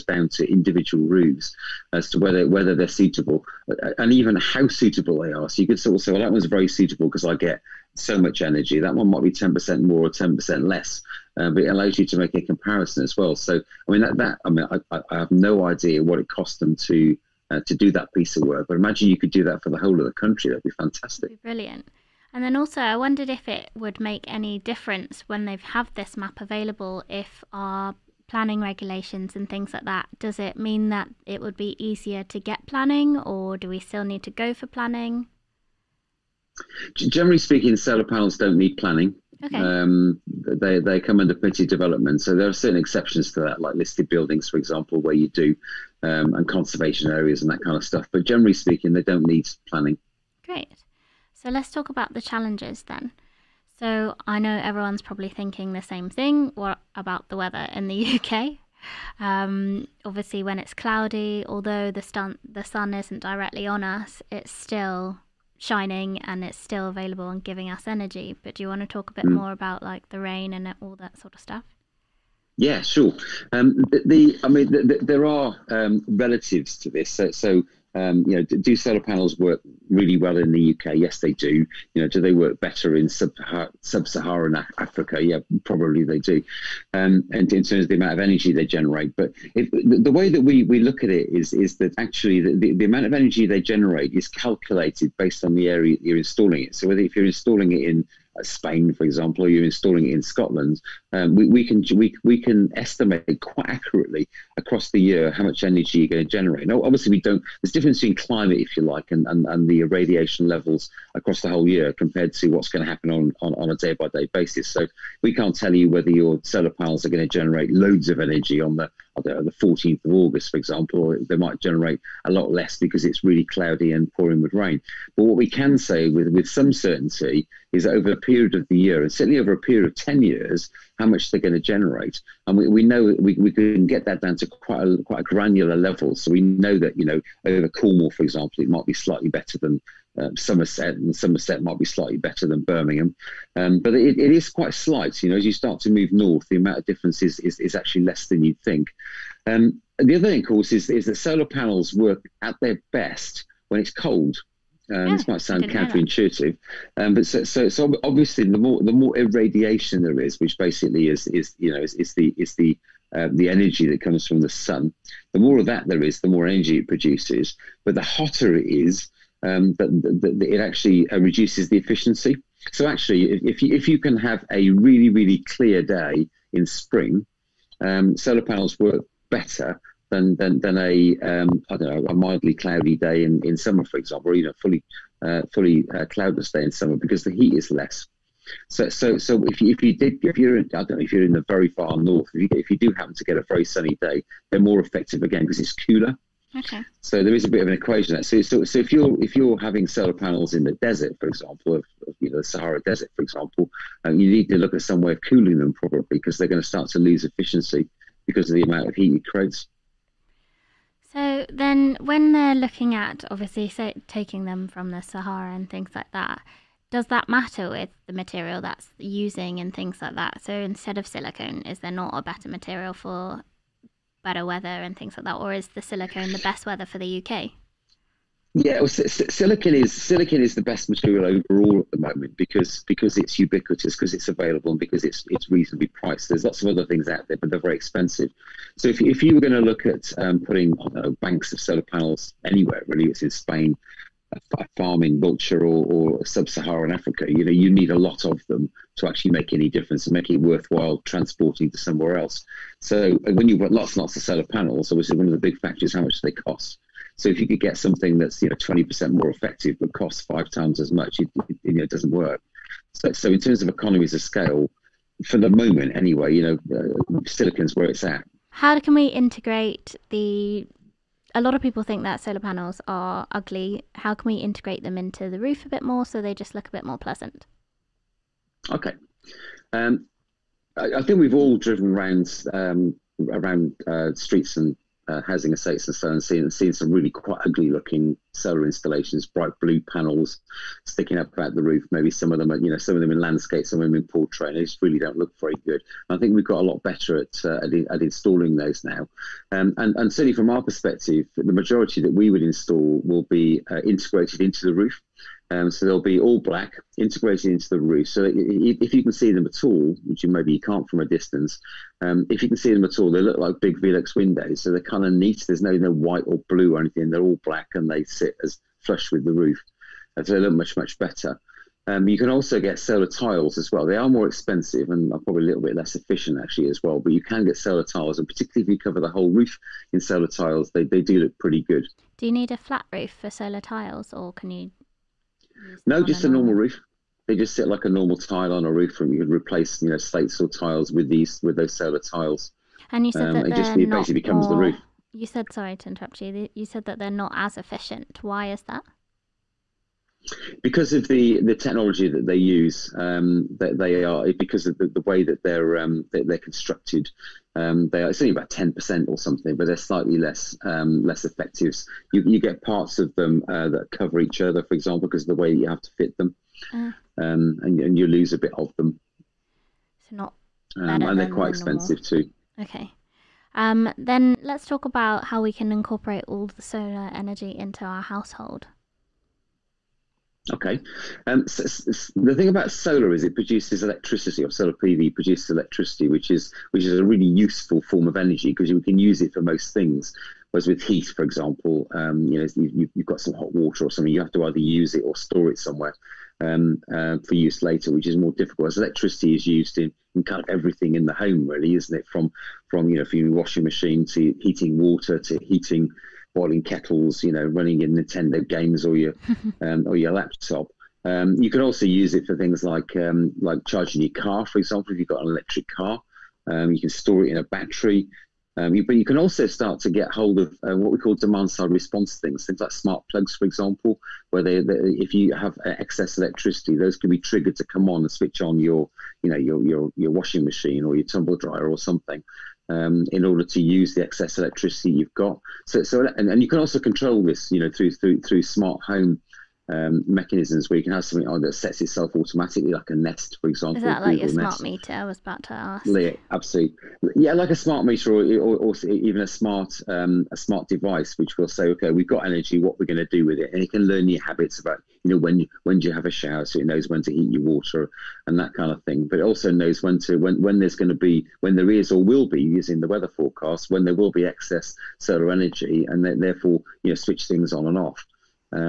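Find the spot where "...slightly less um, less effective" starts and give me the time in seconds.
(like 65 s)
359 s.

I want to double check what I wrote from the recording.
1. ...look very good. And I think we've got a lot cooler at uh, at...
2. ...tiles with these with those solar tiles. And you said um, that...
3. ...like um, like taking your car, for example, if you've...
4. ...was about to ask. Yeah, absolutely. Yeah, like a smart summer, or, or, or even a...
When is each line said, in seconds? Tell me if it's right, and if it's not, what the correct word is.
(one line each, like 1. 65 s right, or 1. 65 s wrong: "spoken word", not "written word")
1. 295 s wrong: "better", not "cooler"
2. 340 s right
3. 412 s wrong: "charging", not "taking"
4. 445 s wrong: "meter", not "summer".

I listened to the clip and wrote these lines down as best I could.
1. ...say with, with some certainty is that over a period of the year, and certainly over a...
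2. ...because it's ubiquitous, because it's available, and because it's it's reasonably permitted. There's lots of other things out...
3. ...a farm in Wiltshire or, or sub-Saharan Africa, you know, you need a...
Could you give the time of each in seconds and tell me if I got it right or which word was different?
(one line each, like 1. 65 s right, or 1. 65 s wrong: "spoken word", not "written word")
1. 125 s right
2. 232 s wrong: "priced", not "permitted"
3. 244 s right.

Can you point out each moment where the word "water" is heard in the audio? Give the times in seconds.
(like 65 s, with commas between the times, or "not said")
393 s, 404 s, 457 s.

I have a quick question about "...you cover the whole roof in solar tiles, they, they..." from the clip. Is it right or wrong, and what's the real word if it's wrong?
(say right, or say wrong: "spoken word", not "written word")
right.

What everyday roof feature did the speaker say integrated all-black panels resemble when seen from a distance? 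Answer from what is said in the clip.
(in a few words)
Velux windows.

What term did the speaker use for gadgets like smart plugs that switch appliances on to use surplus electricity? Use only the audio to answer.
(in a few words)
Demand side response.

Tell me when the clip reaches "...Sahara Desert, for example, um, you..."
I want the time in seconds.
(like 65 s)
202 s.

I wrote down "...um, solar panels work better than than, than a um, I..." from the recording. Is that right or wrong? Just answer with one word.
right.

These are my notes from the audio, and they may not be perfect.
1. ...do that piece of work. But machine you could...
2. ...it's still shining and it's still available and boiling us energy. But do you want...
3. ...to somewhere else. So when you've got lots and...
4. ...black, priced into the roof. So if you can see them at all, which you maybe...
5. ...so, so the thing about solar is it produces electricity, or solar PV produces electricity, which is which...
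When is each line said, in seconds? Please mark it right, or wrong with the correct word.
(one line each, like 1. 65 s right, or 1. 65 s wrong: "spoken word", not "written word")
1. 17 s wrong: "imagine", not "machine"
2. 64 s wrong: "giving", not "boiling"
3. 251 s right
4. 306 s wrong: "integrated", not "priced"
5. 381 s right.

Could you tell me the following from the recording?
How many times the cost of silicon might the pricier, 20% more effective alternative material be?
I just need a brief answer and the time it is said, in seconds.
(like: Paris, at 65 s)
5 times, at 260 s.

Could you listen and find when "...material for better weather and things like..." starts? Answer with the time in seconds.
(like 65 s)
222 s.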